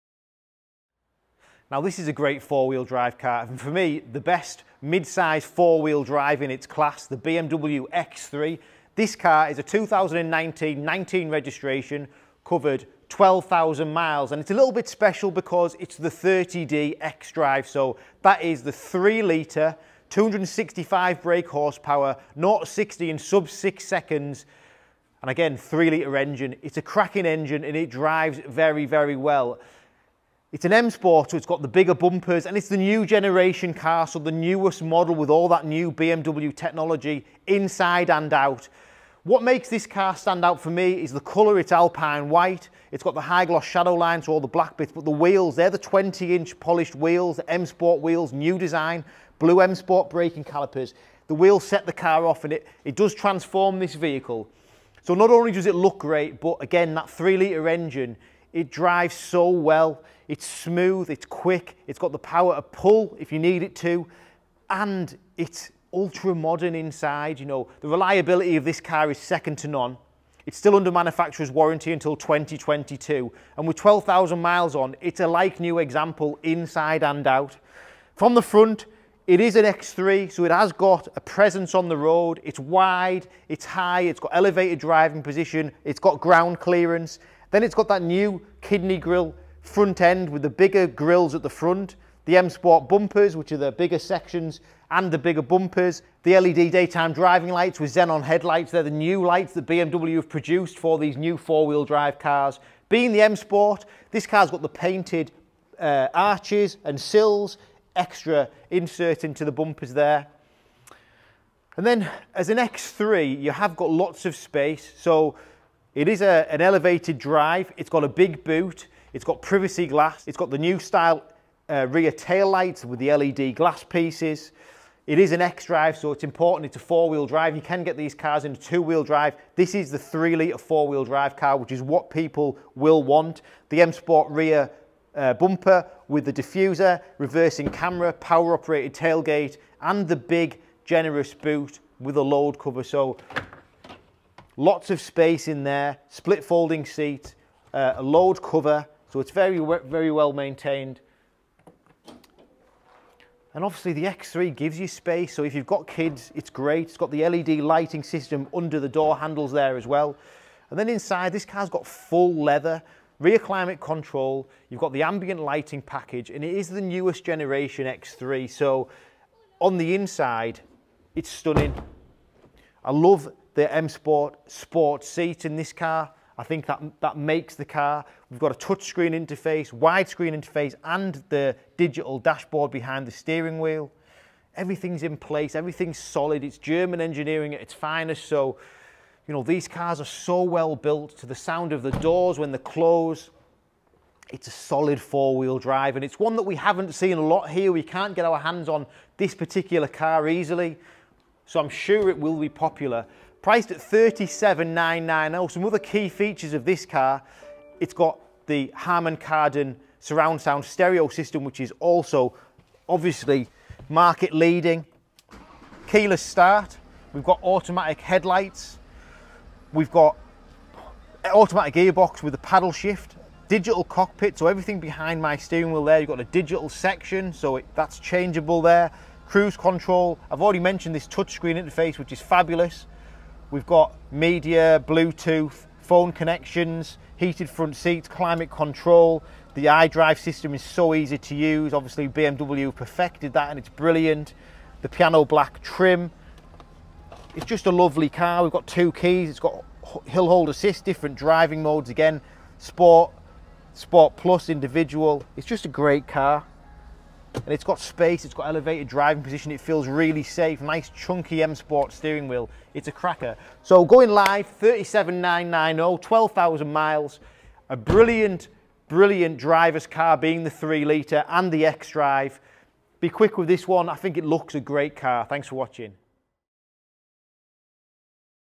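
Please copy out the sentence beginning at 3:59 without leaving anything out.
The iDrive system is so easy to use.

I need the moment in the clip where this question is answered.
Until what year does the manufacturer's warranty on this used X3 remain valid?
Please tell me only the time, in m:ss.
1:12.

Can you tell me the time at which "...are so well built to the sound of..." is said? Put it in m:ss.
3:10.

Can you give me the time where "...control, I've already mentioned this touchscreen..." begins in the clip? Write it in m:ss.
3:49.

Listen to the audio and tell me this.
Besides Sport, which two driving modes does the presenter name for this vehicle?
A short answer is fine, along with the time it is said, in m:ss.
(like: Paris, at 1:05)
Sport Plus, individual, at 4:13.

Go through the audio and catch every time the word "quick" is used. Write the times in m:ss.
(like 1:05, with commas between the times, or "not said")
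1:01, 4:33.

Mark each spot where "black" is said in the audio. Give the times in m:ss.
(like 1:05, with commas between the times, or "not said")
0:44, 4:05.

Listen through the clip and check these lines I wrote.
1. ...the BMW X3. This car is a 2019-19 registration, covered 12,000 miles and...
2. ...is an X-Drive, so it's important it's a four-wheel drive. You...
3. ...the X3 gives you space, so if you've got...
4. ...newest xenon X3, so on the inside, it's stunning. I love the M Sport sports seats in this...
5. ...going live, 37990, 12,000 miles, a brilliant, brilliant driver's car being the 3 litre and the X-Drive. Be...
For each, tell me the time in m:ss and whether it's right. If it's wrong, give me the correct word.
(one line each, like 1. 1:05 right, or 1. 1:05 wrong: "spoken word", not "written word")
1. 0:07 right
2. 2:05 right
3. 2:33 right
4. 2:46 wrong: "generation", not "xenon"
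5. 4:23 right.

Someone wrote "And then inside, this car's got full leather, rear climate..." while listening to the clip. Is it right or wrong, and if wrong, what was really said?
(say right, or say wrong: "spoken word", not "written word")
right.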